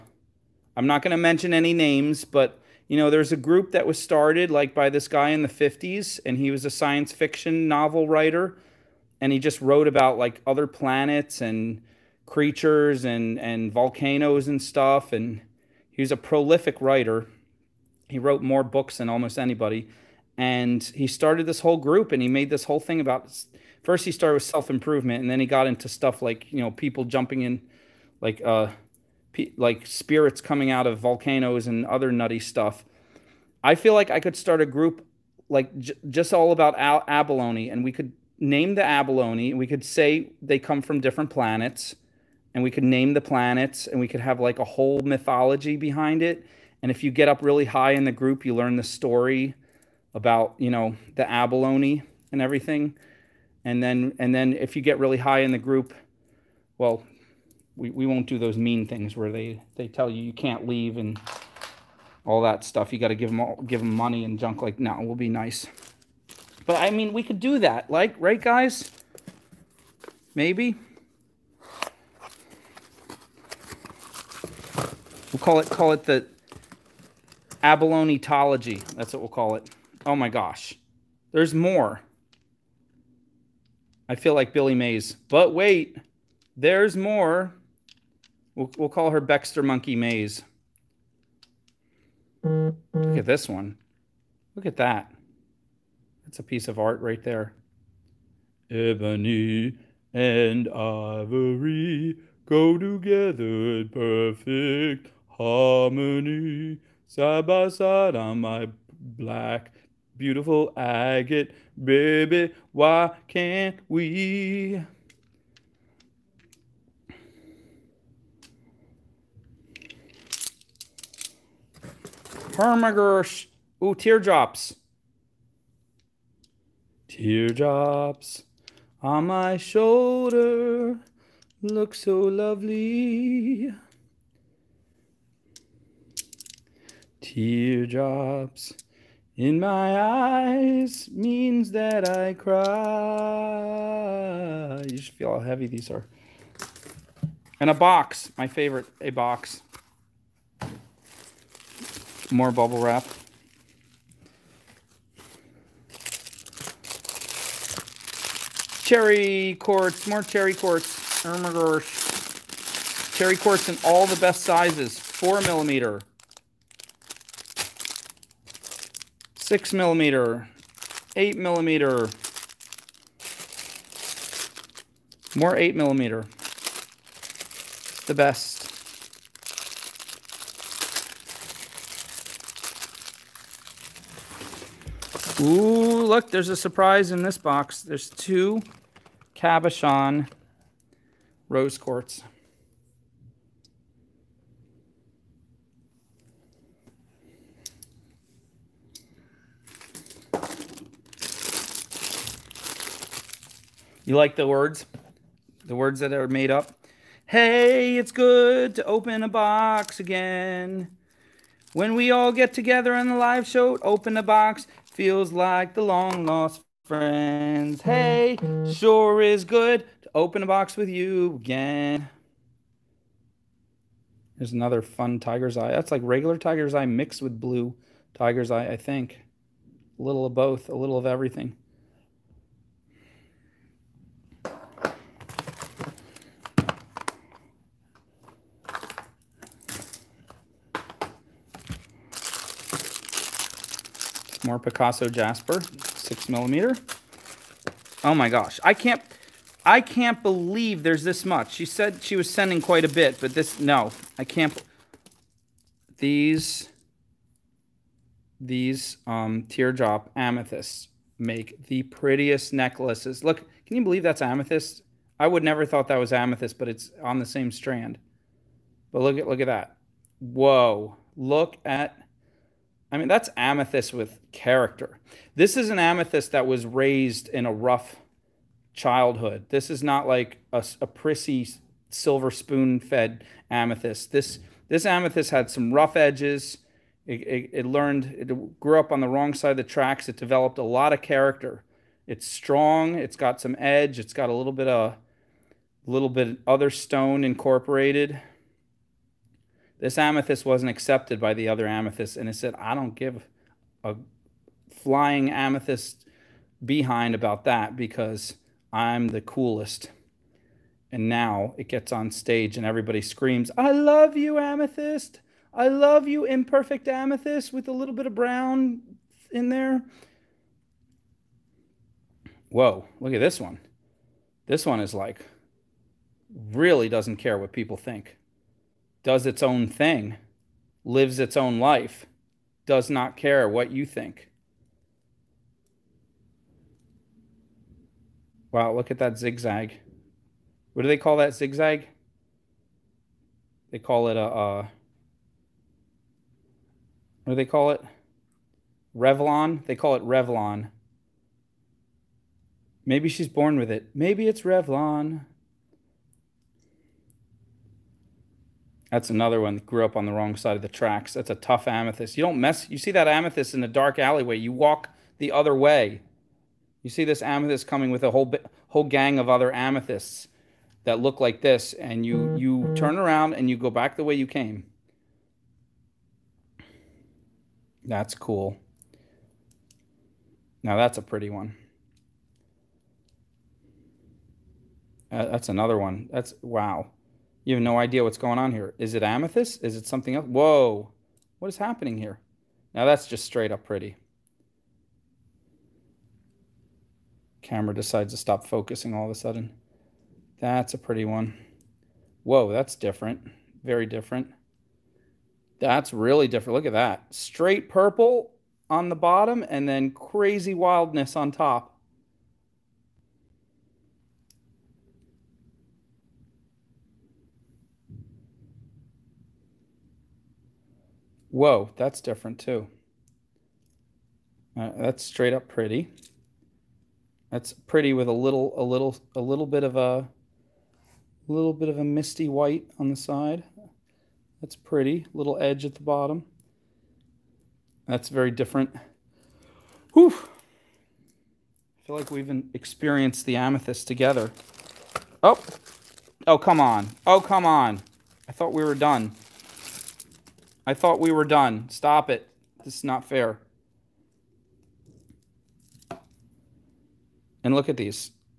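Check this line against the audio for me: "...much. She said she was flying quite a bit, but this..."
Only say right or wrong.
wrong.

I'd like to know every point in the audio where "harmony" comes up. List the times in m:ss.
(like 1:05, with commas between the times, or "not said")
1:45.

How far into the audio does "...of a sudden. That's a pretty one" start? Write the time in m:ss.
6:39.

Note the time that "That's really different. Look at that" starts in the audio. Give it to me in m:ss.
6:45.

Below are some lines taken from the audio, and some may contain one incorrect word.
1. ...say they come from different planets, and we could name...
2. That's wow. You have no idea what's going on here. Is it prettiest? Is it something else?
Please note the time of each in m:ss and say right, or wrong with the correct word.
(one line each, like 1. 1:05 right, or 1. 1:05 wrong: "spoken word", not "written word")
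1. 0:39 right
2. 6:26 wrong: "amethyst", not "prettiest".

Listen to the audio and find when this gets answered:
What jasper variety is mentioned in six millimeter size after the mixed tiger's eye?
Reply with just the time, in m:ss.
4:04.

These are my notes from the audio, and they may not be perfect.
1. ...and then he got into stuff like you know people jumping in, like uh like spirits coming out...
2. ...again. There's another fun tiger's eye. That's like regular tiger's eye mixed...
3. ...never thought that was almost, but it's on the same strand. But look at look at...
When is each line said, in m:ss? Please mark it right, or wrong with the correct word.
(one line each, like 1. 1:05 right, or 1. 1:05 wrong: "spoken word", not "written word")
1. 0:25 right
2. 3:41 right
3. 4:25 wrong: "amethyst", not "almost".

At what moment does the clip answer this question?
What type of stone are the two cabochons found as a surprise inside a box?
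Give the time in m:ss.
3:11.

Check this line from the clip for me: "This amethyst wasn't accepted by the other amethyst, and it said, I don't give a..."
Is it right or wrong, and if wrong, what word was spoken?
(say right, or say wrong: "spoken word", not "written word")
right.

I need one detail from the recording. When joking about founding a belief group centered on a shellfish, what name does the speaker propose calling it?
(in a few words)
the tology.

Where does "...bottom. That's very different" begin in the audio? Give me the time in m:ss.
7:15.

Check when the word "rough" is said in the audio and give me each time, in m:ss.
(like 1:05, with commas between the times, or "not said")
4:37, 4:45.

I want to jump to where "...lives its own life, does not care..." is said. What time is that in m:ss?
5:30.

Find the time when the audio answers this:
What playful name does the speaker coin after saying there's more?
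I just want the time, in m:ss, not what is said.
1:29.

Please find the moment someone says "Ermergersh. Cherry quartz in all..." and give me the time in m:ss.
2:41.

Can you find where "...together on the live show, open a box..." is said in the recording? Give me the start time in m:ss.
3:32.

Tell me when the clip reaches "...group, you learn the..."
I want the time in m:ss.
0:48.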